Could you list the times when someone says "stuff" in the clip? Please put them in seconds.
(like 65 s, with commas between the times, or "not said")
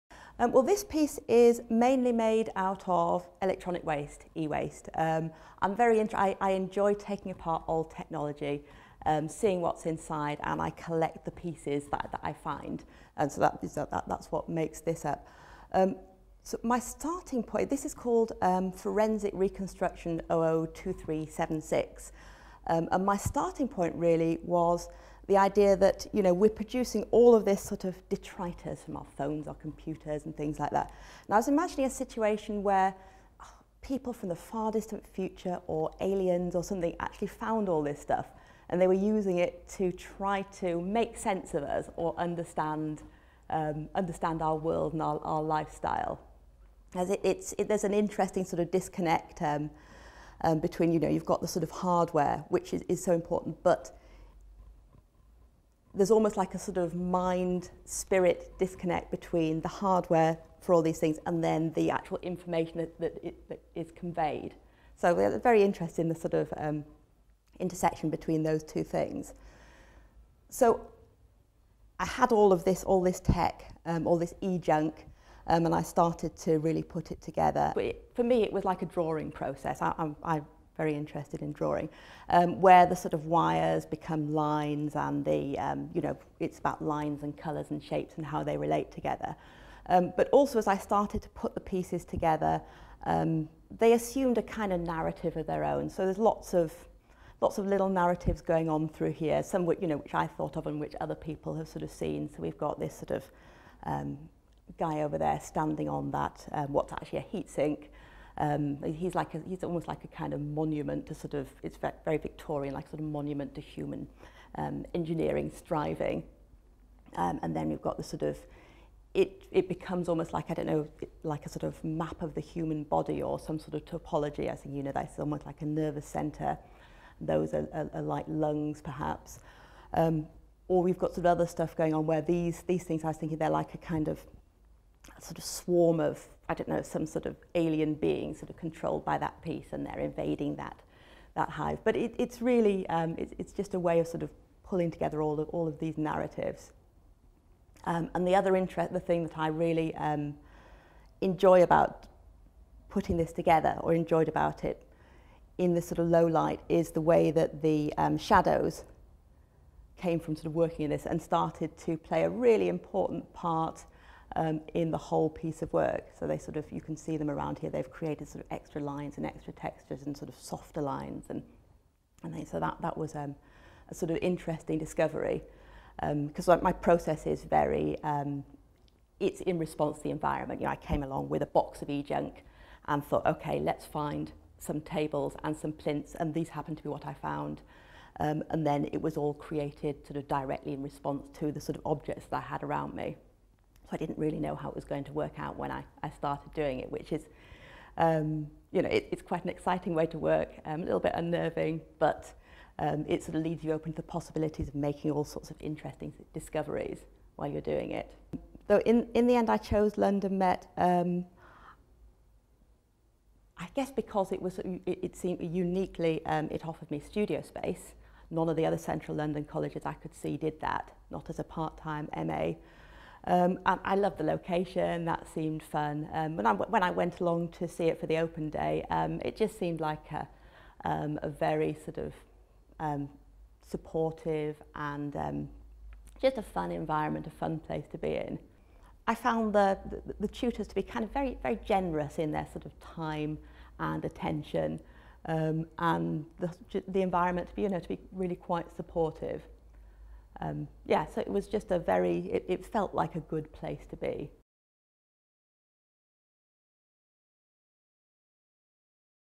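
37 s, 131 s.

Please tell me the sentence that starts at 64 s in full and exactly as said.
So they're very interested in the sort of um, intersection between those two things.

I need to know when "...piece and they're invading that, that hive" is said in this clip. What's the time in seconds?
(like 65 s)
139 s.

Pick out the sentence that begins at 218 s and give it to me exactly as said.
None of the other central London colleges I could see did that, not as a part-time MA.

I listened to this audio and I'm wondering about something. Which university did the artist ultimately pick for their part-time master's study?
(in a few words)
London Met.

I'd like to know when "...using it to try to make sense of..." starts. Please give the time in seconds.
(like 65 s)
38 s.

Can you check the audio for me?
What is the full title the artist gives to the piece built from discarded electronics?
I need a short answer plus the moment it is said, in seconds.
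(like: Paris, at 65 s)
Forensic Reconstruction 002376, at 18 s.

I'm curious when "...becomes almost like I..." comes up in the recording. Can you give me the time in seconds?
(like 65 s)
119 s.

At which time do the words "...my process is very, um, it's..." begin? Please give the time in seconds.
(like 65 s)
176 s.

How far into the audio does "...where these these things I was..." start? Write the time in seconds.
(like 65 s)
132 s.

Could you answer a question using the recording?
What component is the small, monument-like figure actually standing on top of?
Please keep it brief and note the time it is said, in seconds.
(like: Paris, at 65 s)
A heat sink, at 107 s.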